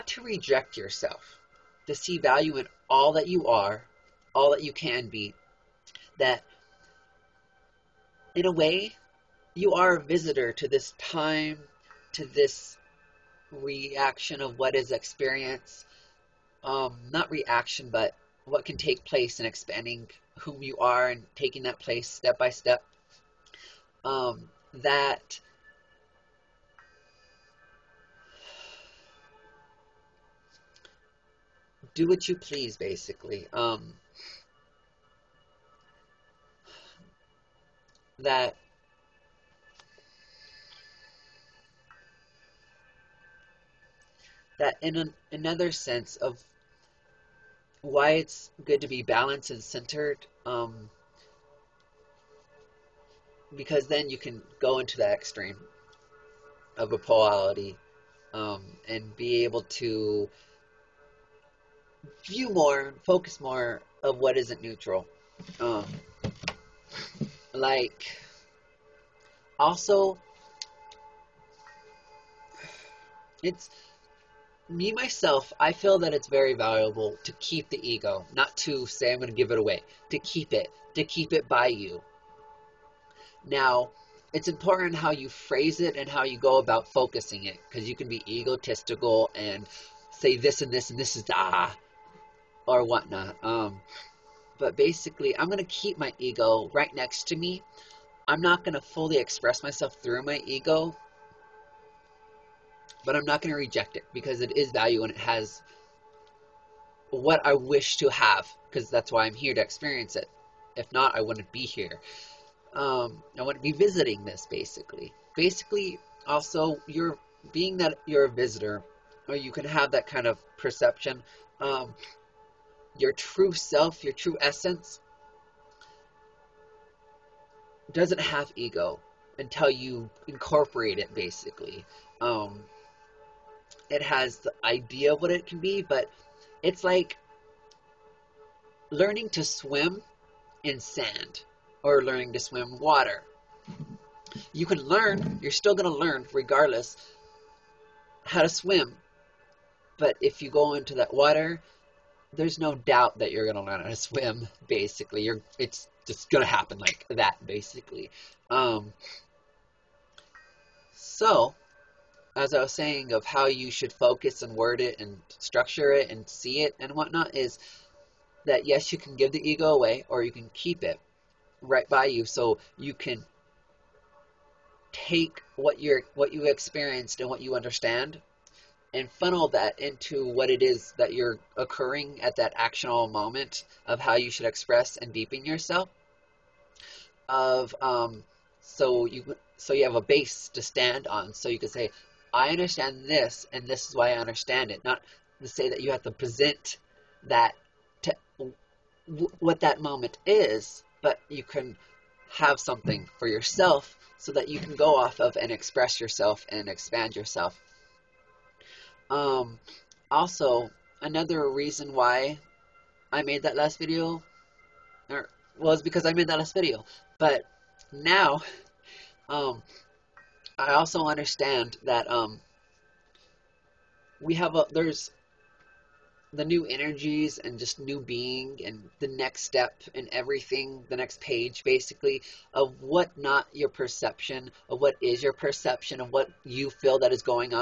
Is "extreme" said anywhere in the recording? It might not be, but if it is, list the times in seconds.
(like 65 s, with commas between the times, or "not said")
55 s.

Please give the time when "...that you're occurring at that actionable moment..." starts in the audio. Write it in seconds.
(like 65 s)
180 s.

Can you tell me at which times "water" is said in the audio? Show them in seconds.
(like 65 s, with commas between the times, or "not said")
142 s, 151 s.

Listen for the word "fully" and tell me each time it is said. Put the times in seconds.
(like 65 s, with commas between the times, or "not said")
98 s.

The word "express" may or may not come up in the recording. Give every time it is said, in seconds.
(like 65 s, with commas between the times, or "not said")
99 s, 184 s, 205 s.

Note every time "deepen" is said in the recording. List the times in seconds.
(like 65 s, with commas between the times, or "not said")
185 s.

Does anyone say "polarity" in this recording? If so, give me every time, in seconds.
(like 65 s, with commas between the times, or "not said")
56 s.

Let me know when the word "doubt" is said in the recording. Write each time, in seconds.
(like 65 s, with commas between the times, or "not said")
152 s.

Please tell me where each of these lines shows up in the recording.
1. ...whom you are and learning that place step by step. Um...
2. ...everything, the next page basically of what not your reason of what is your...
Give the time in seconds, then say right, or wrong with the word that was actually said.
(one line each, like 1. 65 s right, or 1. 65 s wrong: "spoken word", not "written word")
1. 20 s wrong: "taking", not "learning"
2. 230 s wrong: "perception", not "reason".